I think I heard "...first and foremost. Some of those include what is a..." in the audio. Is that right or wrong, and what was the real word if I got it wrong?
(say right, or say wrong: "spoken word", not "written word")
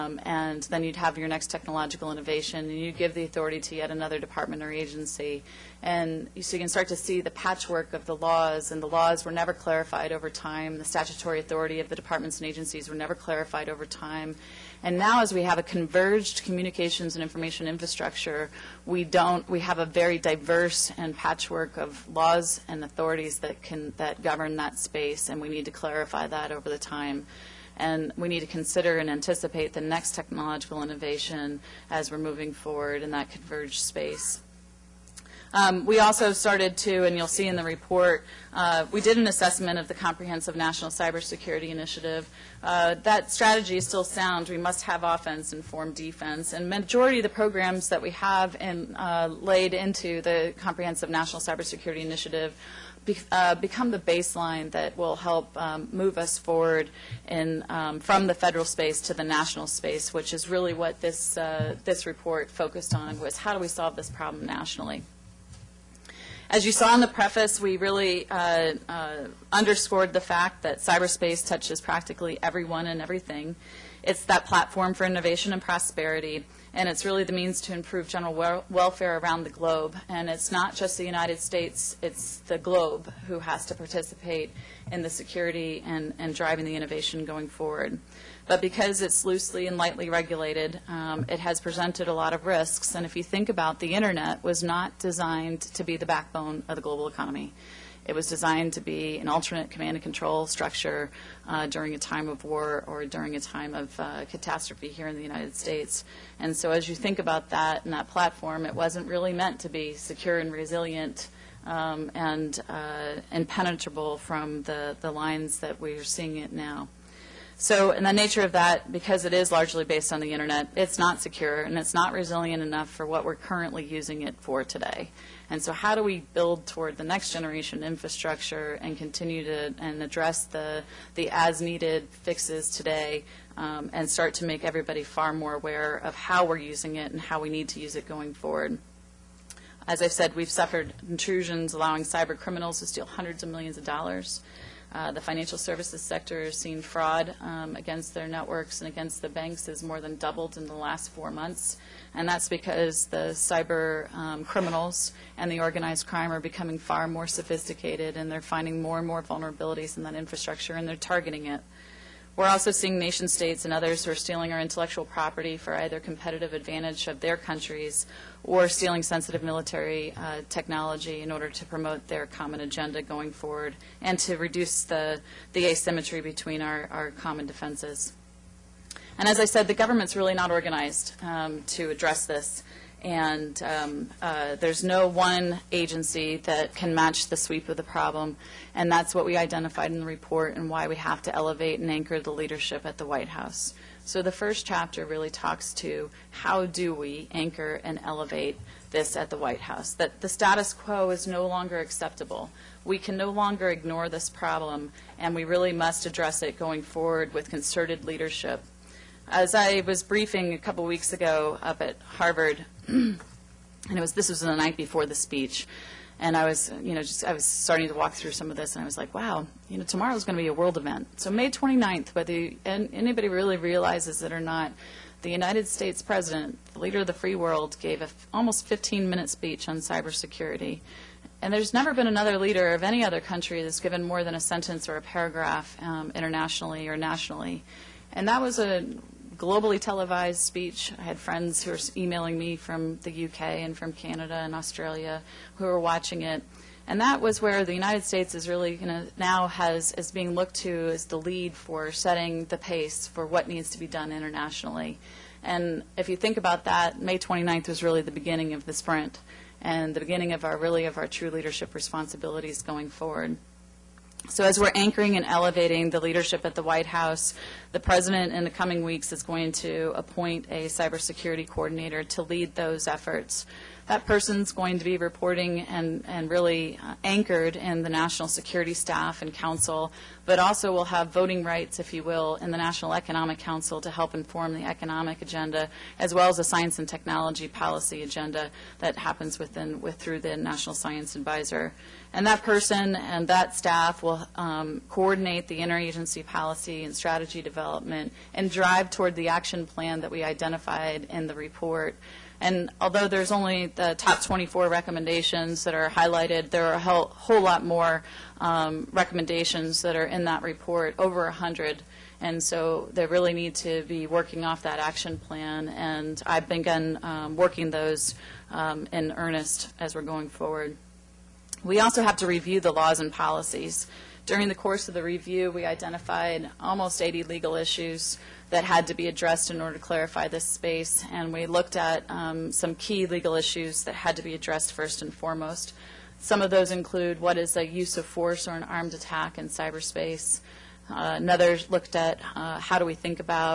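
right.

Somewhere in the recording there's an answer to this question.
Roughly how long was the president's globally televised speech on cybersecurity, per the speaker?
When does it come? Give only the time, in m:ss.
3:48.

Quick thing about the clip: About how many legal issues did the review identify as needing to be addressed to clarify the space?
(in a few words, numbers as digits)
almost 80.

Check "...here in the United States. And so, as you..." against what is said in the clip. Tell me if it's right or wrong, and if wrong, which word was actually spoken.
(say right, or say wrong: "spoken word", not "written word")
right.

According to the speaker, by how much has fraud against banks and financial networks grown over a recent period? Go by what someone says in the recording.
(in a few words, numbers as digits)
more than doubled.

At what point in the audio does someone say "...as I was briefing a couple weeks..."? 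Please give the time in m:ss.
3:29.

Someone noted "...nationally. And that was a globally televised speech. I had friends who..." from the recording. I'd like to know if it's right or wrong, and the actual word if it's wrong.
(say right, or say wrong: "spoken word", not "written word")
right.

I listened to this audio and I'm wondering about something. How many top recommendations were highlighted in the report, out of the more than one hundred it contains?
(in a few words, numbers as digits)
24.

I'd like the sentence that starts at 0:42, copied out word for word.
Uh, that strategy is still sound.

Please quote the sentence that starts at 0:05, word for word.
And you, so you can start to see the patchwork of the laws, and the laws were never clarified over time.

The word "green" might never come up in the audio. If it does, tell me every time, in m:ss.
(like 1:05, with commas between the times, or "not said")
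not said.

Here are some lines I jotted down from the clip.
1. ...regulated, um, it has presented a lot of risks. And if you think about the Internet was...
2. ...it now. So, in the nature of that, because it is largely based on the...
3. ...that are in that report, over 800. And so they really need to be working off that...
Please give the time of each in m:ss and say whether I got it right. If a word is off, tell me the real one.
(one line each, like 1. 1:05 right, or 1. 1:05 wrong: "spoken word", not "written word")
1. 1:30 right
2. 1:56 right
3. 5:09 wrong: "100", not "800".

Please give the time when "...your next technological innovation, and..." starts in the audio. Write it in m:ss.
0:01.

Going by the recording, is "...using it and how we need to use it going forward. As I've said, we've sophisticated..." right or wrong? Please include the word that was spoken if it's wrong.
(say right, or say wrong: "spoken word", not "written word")
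wrong: "suffered", not "sophisticated".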